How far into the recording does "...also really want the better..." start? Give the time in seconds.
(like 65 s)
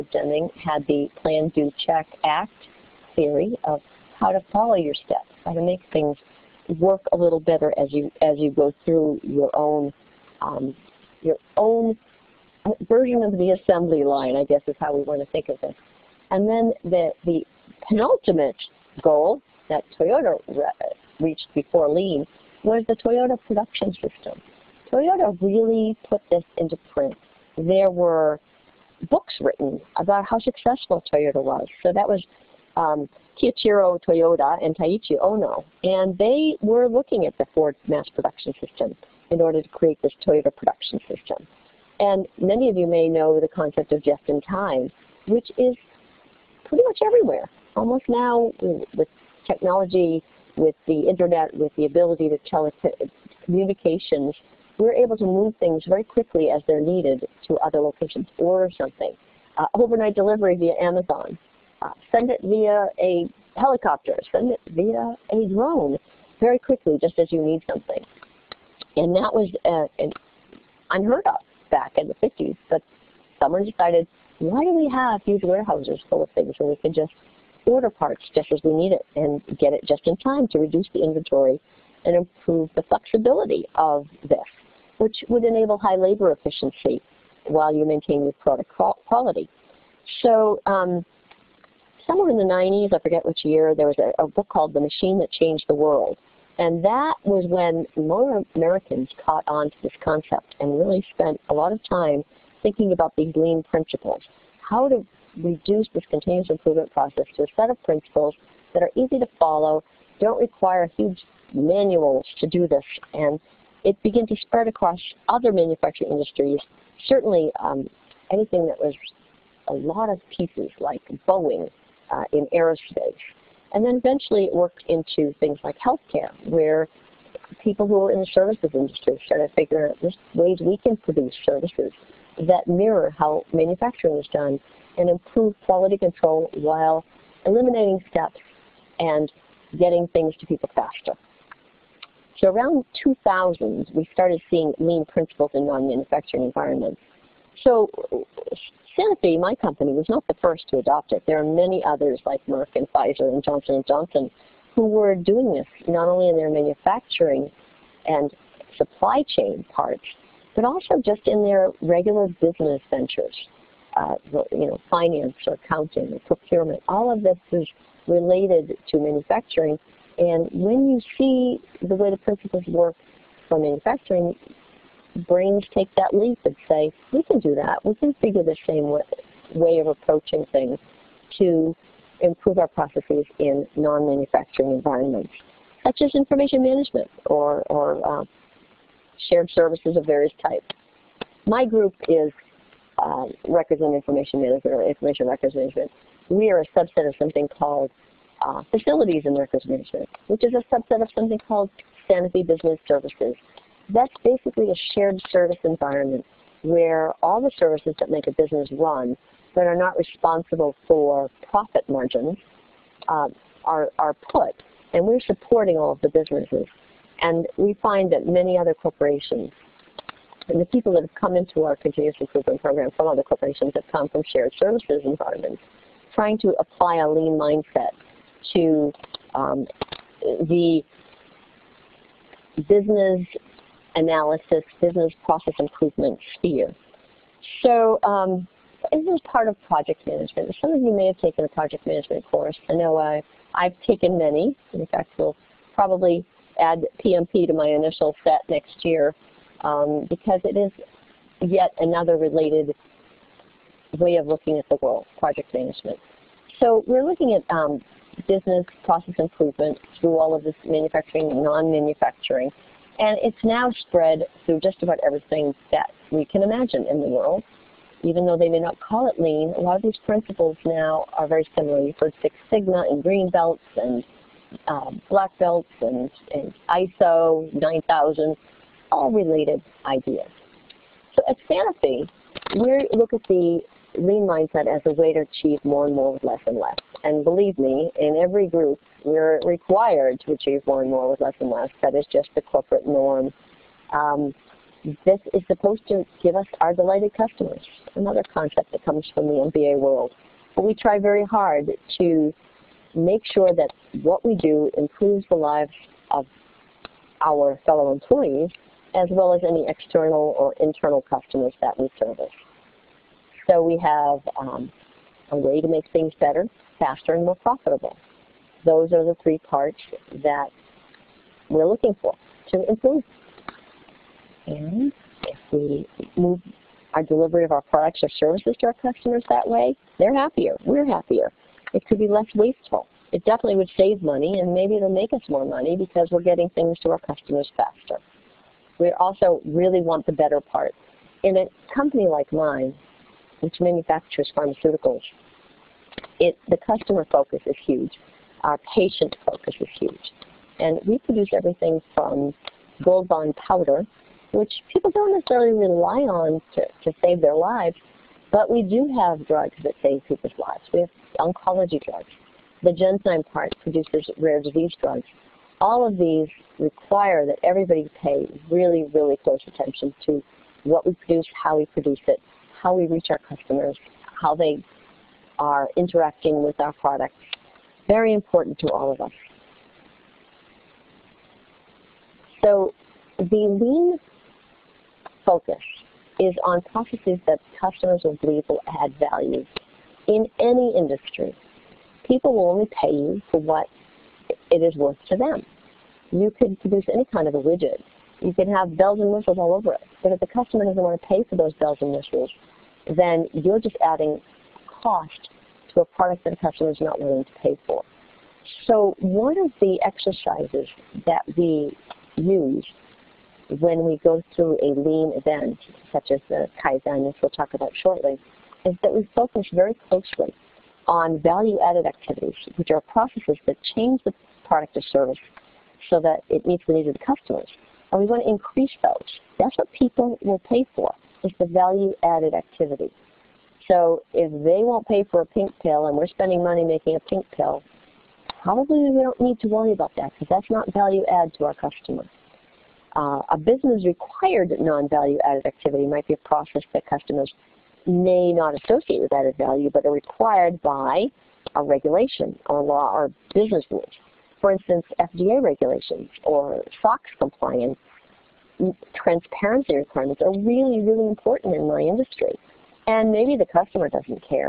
338 s.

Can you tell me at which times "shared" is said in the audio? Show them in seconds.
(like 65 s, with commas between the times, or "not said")
189 s, 204 s, 224 s.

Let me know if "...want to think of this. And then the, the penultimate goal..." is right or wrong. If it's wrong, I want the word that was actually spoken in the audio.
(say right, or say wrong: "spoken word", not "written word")
right.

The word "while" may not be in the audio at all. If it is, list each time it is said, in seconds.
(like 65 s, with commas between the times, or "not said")
87 s, 136 s.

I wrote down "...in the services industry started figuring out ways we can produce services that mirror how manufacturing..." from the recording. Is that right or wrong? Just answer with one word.
right.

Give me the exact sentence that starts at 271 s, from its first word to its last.
You've heard Six Sigma and green belts and uh, black belts and, and ISO 9000 all related ideas.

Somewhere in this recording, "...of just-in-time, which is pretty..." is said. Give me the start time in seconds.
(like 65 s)
43 s.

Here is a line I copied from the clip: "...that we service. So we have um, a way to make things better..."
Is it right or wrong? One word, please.
right.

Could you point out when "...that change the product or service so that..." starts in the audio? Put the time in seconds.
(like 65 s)
423 s.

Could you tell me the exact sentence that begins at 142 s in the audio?
So around 2000, we started seeing lean principles in non-manufacturing environments.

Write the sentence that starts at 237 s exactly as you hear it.
So um, this is part of project management.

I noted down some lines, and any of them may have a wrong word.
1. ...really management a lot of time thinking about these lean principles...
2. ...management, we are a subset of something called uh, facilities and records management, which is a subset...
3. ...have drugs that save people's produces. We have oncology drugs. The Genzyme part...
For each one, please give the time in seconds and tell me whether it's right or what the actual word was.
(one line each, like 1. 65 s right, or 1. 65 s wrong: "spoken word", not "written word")
1. 100 s wrong: "spent", not "management"
2. 195 s right
3. 358 s wrong: "lives", not "produces".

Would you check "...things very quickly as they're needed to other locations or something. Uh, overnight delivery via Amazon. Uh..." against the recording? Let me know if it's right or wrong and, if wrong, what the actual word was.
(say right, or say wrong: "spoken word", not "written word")
right.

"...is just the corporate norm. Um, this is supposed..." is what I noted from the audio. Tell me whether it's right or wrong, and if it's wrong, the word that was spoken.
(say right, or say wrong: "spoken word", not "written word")
right.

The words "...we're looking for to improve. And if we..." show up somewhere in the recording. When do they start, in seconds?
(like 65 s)
321 s.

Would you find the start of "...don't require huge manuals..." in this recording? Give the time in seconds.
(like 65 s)
110 s.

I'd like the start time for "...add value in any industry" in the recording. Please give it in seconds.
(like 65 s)
388 s.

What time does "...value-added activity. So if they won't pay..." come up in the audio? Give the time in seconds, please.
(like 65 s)
431 s.